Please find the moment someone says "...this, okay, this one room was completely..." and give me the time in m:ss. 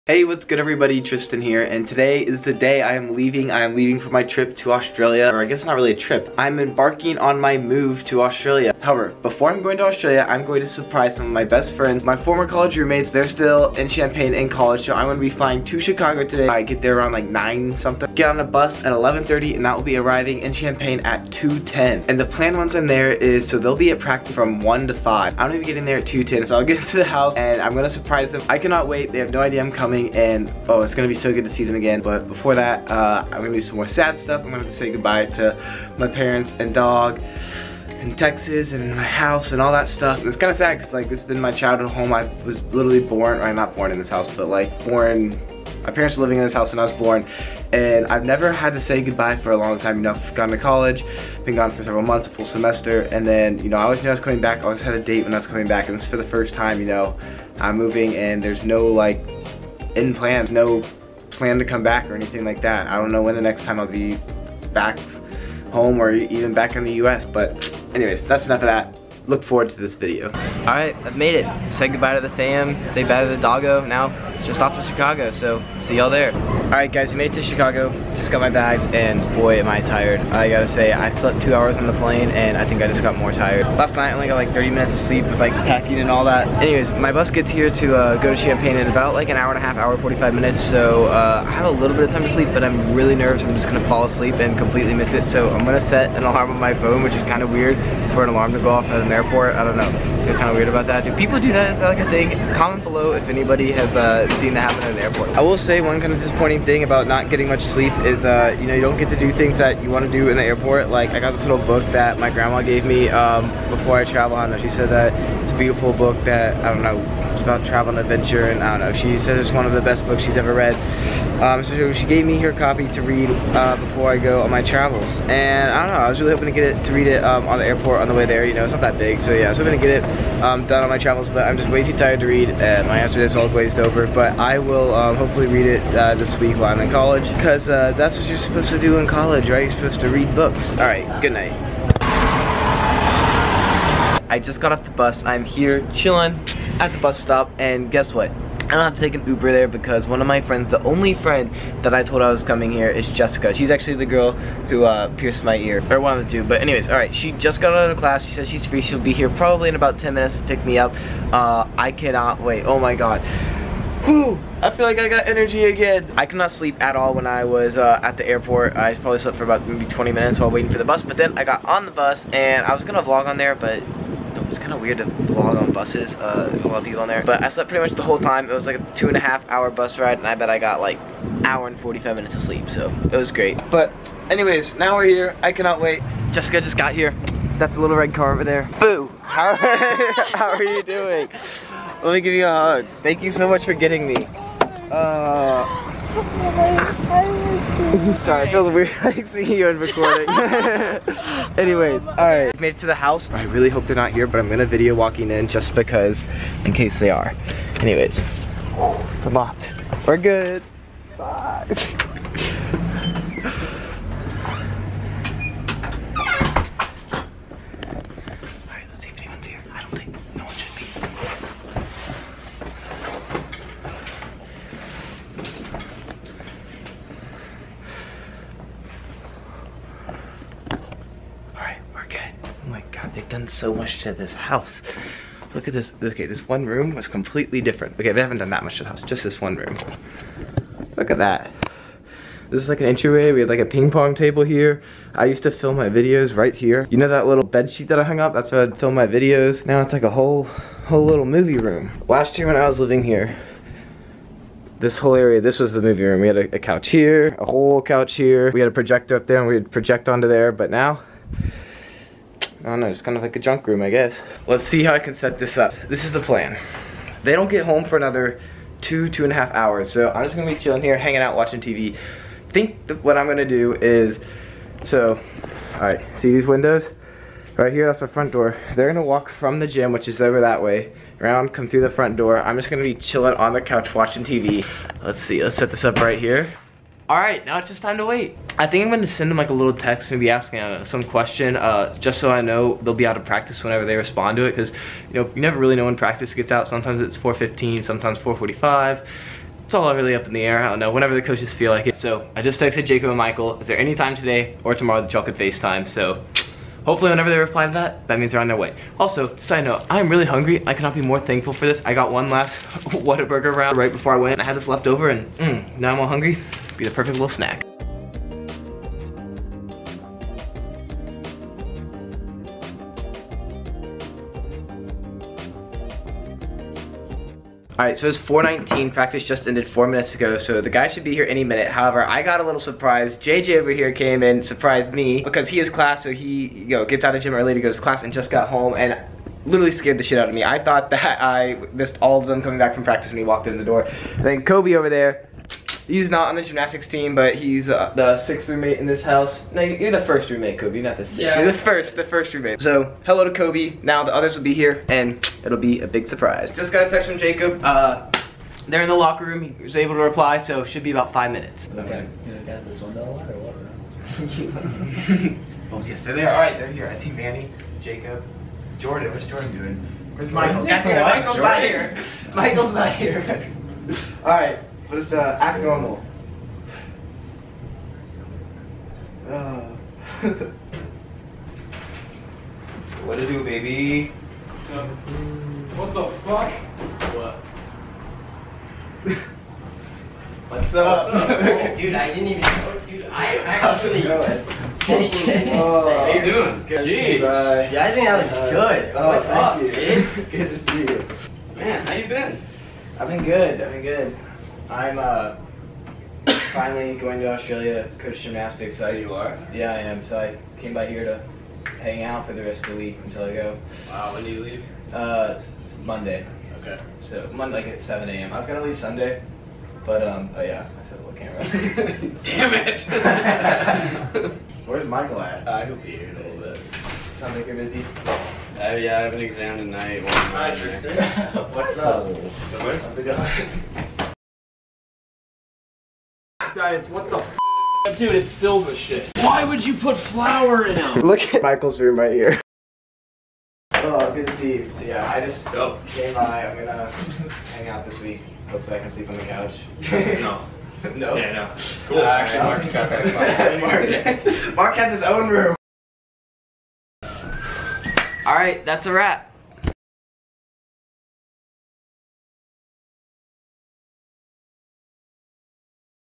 3:55.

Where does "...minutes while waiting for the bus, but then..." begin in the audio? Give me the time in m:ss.
2:50.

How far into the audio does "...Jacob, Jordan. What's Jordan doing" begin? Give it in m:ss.
6:07.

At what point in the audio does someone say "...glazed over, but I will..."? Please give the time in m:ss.
2:13.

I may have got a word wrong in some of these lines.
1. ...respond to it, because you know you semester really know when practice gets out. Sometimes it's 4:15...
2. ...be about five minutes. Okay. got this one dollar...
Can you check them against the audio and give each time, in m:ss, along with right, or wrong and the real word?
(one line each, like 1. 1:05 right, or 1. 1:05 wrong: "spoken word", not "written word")
1. 4:53 wrong: "never", not "semester"
2. 6:00 right.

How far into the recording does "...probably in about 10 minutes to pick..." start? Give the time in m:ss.
2:39.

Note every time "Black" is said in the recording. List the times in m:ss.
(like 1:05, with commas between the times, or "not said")
7:16.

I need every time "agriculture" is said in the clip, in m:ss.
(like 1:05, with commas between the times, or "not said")
not said.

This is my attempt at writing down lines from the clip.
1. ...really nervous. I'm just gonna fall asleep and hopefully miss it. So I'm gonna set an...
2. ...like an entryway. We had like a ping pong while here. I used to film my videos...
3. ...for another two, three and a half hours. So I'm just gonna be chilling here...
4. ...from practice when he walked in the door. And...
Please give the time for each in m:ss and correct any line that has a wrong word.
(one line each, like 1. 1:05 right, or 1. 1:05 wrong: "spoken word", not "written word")
1. 1:32 wrong: "completely", not "hopefully"
2. 4:02 wrong: "table", not "while"
3. 4:27 wrong: "two", not "three"
4. 5:42 right.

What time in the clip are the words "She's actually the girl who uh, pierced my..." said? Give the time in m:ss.
2:33.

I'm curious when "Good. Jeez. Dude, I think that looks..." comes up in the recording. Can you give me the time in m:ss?
6:36.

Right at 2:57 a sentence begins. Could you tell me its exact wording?
But I slept pretty much the whole time.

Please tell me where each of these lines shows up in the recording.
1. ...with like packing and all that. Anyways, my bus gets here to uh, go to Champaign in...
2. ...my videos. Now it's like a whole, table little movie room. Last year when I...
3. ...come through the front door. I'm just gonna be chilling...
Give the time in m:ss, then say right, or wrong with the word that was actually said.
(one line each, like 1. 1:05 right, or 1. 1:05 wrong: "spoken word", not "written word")
1. 1:25 right
2. 4:08 wrong: "whole", not "table"
3. 4:41 right.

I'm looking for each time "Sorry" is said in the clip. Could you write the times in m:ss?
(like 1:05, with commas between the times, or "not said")
3:18.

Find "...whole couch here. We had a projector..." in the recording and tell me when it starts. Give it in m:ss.
4:17.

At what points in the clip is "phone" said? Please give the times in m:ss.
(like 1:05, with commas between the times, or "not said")
1:36.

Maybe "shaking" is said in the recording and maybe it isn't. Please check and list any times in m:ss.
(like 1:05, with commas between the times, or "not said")
not said.